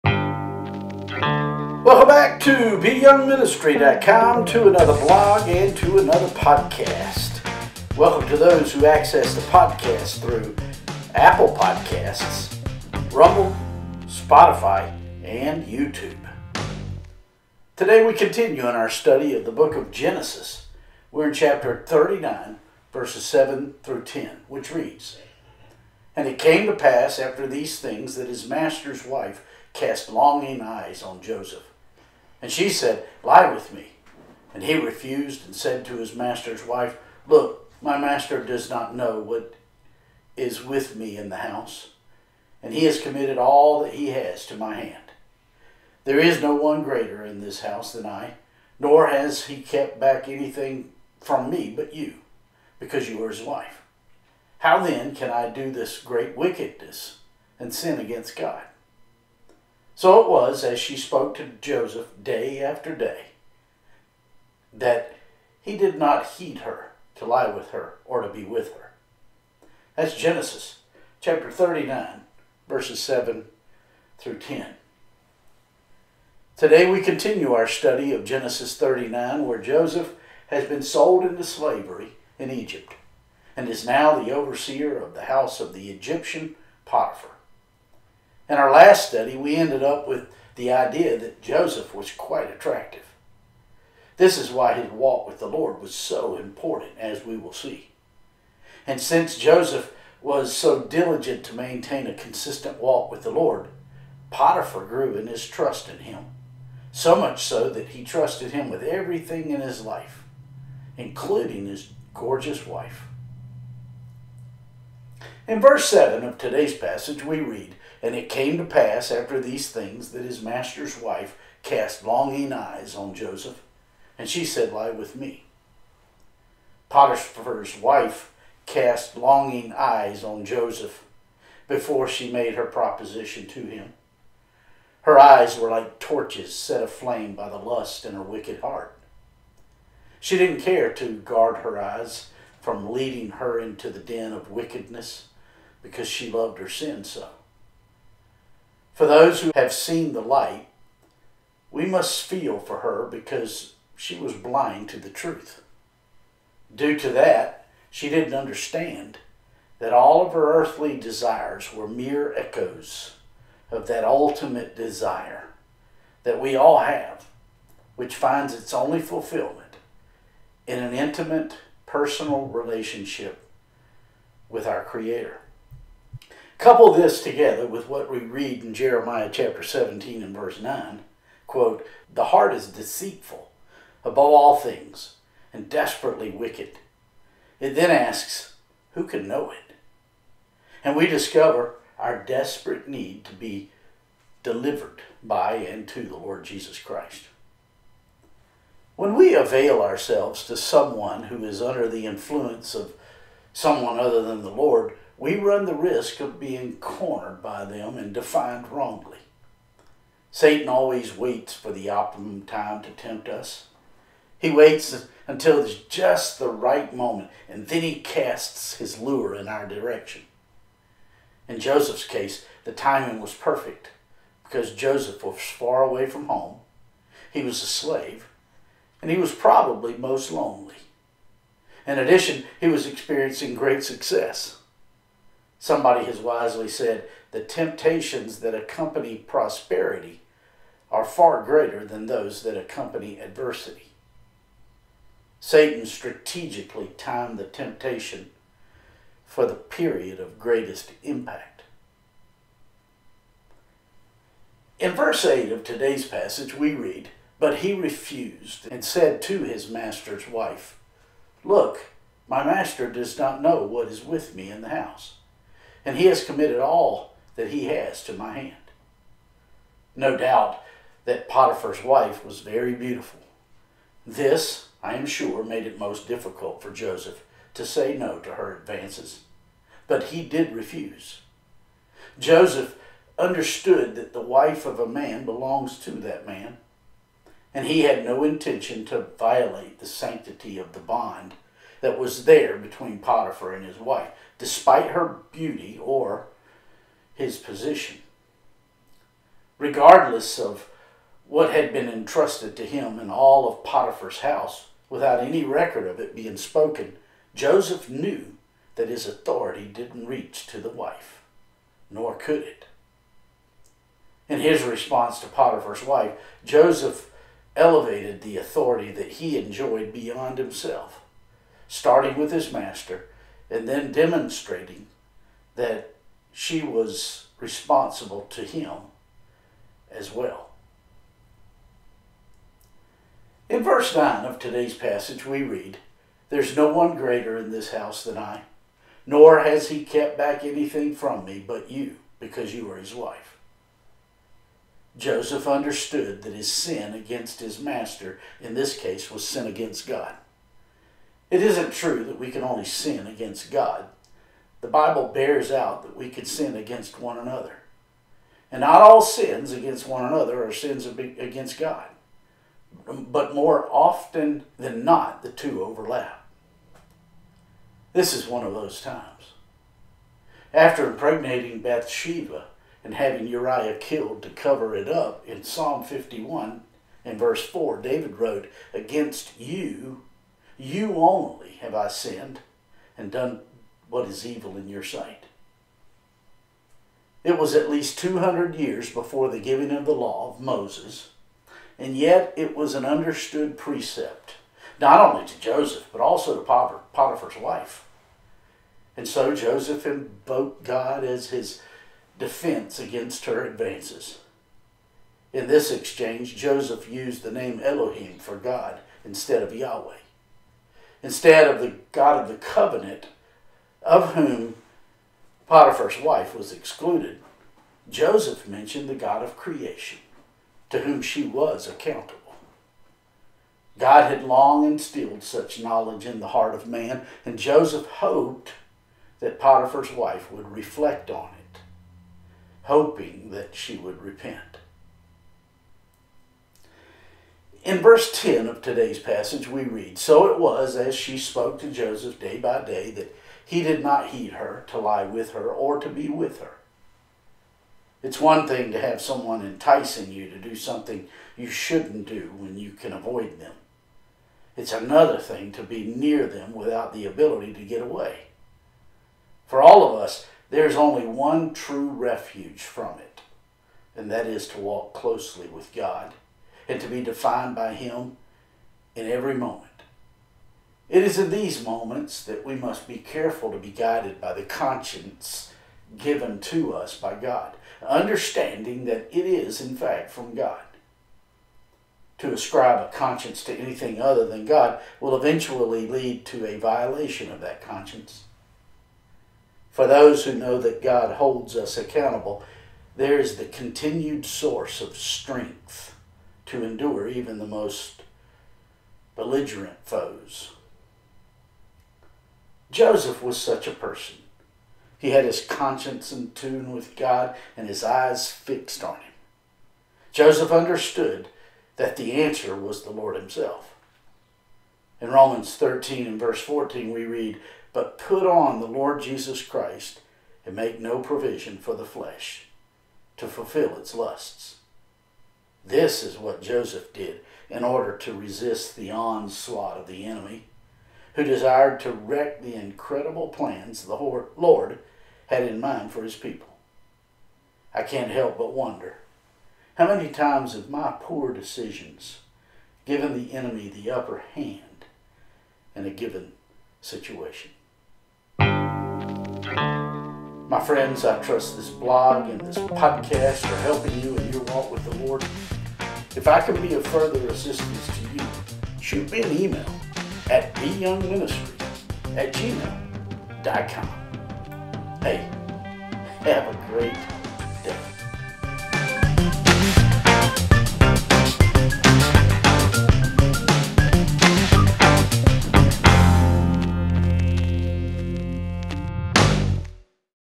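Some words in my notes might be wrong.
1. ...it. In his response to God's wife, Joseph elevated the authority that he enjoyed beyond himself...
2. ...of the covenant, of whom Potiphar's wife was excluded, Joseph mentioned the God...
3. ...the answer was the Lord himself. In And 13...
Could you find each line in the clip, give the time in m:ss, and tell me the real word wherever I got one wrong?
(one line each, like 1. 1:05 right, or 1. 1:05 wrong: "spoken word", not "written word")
1. 5:12 wrong: "Potiphar", not "God"
2. 6:52 right
3. 8:31 wrong: "Romans", not "And".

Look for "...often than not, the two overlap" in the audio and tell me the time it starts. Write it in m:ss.
6:03.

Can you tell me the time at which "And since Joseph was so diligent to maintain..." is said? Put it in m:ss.
1:38.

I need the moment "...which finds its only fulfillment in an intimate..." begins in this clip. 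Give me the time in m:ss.
2:47.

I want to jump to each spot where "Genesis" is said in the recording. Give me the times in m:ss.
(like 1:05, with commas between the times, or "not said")
0:19, 1:10, 1:18.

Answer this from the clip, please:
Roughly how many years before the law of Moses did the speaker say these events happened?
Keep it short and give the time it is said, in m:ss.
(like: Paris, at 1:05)
200, at 6:27.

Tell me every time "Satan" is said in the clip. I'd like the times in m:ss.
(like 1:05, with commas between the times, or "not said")
3:30, 4:05.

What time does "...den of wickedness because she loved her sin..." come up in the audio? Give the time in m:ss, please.
2:23.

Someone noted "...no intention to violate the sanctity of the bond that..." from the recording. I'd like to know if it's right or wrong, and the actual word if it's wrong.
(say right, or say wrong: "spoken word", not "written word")
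right.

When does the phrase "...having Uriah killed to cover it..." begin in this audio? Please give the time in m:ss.
6:12.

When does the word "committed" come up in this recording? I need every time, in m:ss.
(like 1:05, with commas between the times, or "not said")
0:43, 4:26.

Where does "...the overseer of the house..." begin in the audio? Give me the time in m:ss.
1:24.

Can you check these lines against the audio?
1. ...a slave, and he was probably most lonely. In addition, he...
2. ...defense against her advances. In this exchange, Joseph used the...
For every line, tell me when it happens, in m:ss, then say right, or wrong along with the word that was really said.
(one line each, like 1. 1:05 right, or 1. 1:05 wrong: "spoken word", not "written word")
1. 3:47 right
2. 6:42 right.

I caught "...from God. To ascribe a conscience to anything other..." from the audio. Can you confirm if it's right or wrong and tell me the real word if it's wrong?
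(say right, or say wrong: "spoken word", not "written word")
right.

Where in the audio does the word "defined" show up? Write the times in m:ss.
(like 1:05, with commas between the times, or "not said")
3:28, 7:47.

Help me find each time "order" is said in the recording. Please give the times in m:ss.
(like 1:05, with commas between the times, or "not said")
8:47.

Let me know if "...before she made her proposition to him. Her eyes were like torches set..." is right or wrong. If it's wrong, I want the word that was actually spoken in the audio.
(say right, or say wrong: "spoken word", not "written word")
right.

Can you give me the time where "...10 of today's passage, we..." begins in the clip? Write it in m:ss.
7:18.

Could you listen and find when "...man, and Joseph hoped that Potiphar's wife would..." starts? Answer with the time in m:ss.
7:06.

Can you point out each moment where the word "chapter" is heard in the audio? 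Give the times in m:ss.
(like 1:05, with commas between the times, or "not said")
0:21, 1:11, 2:59.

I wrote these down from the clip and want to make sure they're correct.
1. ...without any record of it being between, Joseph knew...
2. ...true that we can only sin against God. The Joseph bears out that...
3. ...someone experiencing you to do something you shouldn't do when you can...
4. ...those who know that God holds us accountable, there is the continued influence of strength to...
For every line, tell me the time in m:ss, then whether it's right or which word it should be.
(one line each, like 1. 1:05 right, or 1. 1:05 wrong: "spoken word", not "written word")
1. 5:04 wrong: "spoken", not "between"
2. 5:51 wrong: "Bible", not "Joseph"
3. 7:28 wrong: "enticing", not "experiencing"
4. 8:09 wrong: "source", not "influence".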